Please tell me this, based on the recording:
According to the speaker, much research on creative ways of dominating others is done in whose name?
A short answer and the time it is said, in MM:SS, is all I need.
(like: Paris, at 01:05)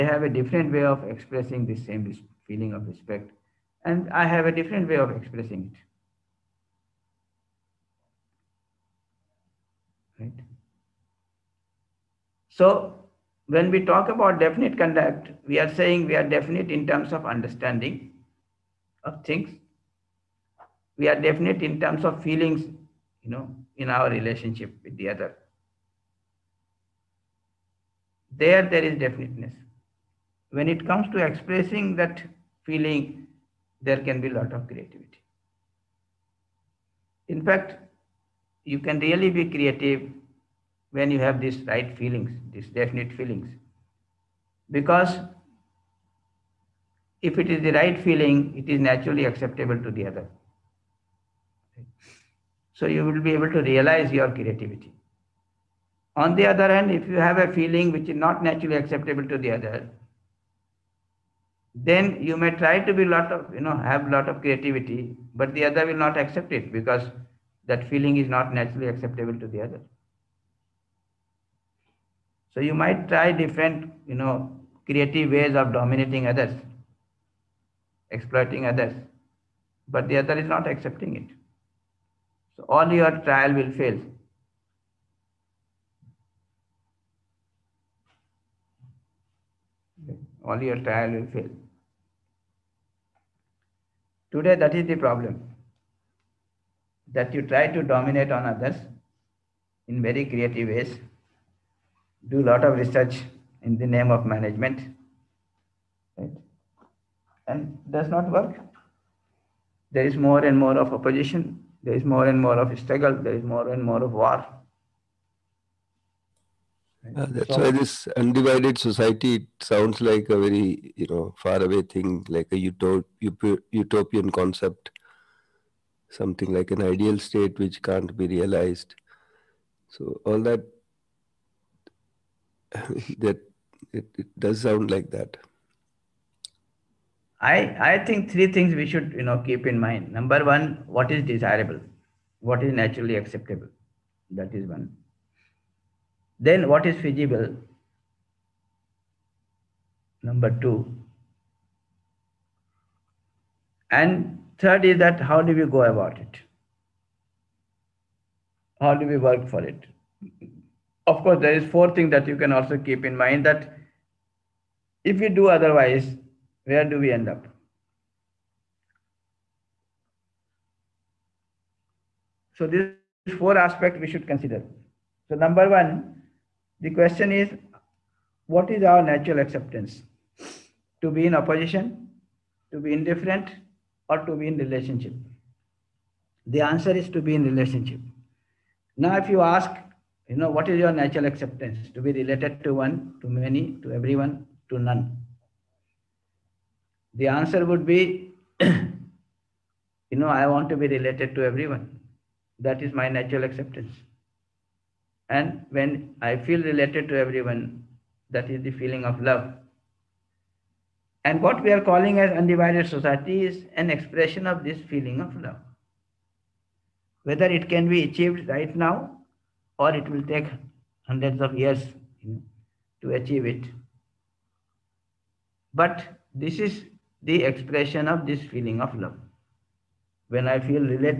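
management, at 01:44.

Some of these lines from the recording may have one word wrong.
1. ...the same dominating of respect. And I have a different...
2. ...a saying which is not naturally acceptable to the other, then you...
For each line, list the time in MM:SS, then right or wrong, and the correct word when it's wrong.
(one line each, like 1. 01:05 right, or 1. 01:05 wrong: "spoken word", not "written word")
1. 00:01 wrong: "feeling", not "dominating"
2. 00:57 wrong: "feeling", not "saying".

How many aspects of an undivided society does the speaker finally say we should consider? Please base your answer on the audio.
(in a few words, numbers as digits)
4.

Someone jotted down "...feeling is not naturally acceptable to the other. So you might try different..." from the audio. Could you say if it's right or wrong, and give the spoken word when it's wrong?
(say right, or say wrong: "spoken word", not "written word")
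right.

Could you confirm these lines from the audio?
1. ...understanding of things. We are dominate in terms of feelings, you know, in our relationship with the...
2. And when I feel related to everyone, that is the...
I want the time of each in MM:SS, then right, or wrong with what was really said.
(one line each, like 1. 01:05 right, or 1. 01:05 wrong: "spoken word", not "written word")
1. 00:17 wrong: "definite", not "dominate"
2. 03:25 right.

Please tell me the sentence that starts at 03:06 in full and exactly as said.
The answer is to be in relationship.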